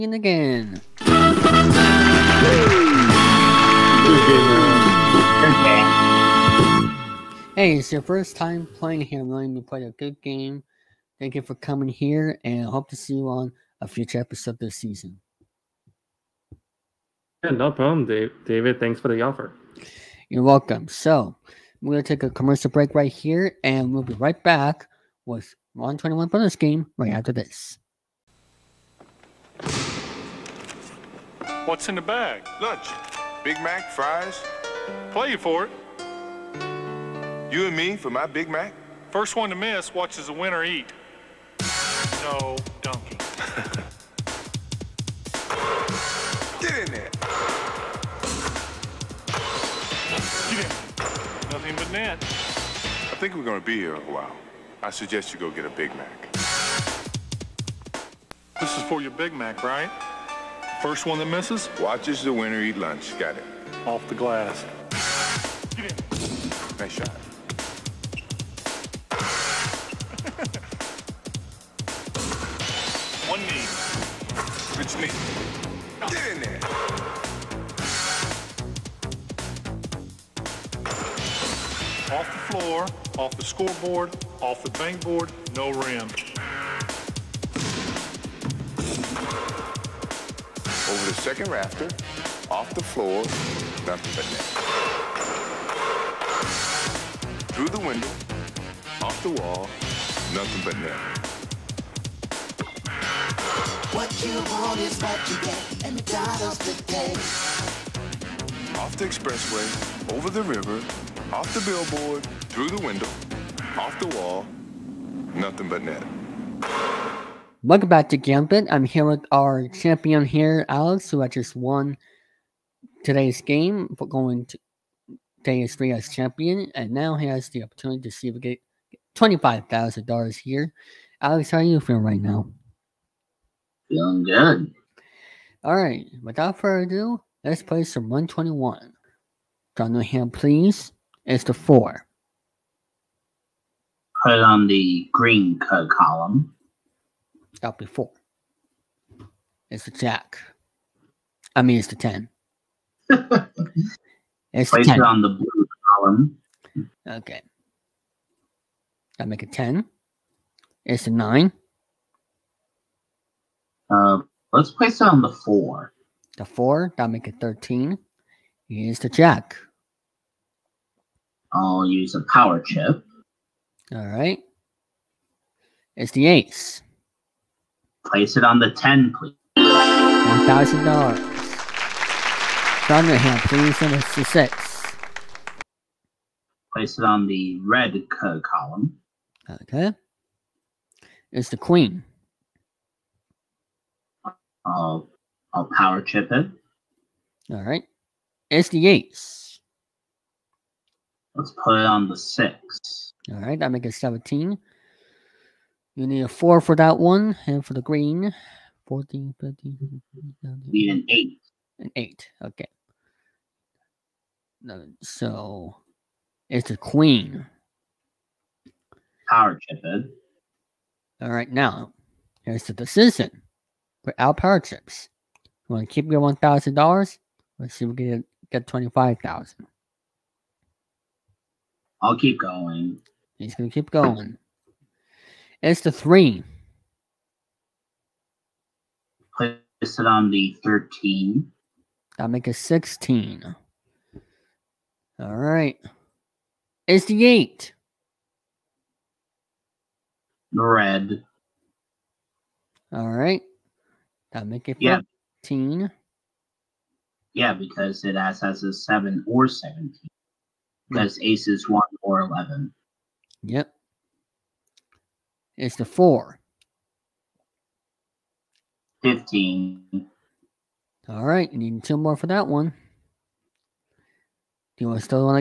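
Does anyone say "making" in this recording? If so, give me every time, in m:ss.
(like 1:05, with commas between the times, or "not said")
not said.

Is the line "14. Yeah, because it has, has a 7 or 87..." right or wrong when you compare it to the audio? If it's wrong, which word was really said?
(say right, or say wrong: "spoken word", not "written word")
wrong: "17", not "87".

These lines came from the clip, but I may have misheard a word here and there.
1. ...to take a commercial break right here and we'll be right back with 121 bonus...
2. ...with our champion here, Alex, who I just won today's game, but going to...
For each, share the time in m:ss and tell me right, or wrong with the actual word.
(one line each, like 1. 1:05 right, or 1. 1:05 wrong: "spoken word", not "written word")
1. 0:22 right
2. 1:59 right.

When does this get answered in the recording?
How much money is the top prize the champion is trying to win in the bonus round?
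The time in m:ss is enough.
2:09.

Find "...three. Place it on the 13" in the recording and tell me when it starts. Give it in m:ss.
3:55.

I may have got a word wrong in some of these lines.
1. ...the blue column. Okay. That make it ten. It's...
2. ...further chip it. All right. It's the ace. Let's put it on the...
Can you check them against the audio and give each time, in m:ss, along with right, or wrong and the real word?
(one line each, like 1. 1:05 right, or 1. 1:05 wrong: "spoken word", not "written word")
1. 2:35 right
2. 3:15 wrong: "power", not "further".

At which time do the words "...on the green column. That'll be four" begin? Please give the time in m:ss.
2:24.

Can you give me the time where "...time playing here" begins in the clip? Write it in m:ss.
0:08.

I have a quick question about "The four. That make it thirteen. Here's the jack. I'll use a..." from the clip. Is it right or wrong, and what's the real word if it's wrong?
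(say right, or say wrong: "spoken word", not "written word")
right.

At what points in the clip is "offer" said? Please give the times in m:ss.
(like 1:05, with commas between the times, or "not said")
0:19.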